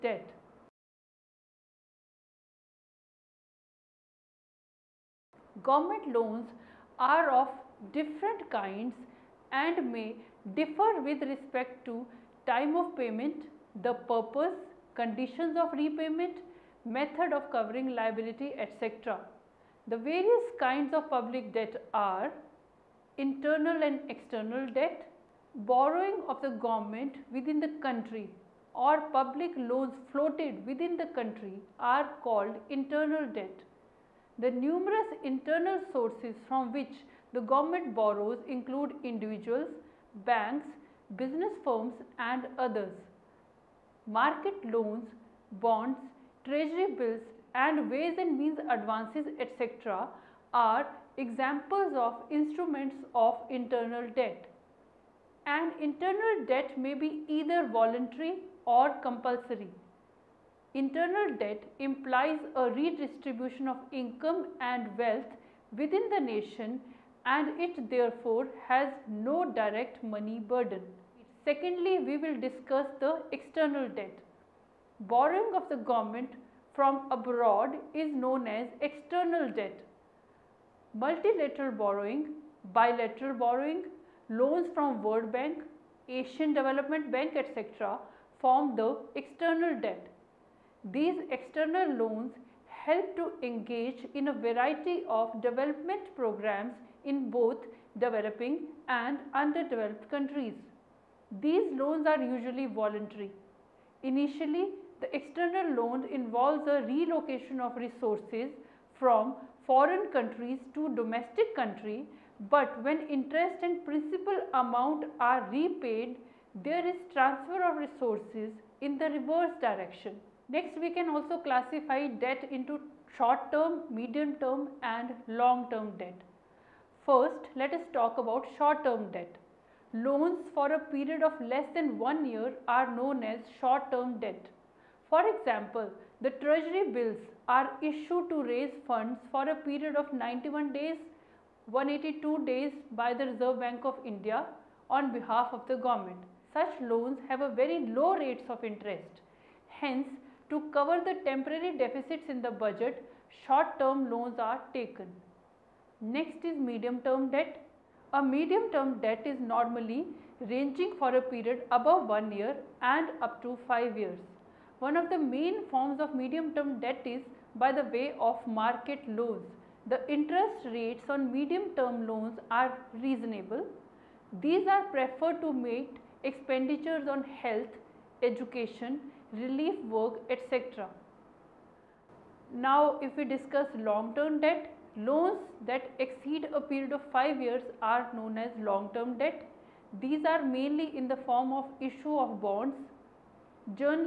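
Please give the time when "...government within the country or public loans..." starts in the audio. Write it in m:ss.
0:26.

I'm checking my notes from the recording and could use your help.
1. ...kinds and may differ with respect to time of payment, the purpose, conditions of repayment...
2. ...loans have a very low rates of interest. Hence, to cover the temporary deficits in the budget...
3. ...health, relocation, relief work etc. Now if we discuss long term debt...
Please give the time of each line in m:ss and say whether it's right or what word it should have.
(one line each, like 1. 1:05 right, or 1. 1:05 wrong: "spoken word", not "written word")
1. 0:08 right
2. 2:26 right
3. 2:57 wrong: "education", not "relocation".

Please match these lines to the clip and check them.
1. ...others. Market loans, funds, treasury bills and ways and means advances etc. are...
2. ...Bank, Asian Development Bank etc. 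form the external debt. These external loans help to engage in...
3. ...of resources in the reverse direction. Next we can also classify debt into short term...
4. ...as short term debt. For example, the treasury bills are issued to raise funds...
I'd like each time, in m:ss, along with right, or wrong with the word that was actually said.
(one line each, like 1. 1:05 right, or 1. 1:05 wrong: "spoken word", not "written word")
1. 0:42 wrong: "bonds", not "funds"
2. 1:25 right
3. 1:57 right
4. 2:13 right.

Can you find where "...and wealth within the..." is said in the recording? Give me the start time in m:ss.
1:04.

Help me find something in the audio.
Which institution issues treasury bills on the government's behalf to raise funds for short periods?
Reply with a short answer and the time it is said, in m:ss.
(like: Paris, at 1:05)
Reserve Bank of India, at 2:23.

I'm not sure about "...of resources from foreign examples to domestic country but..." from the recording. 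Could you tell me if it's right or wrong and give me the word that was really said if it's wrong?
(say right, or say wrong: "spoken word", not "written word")
wrong: "countries", not "examples".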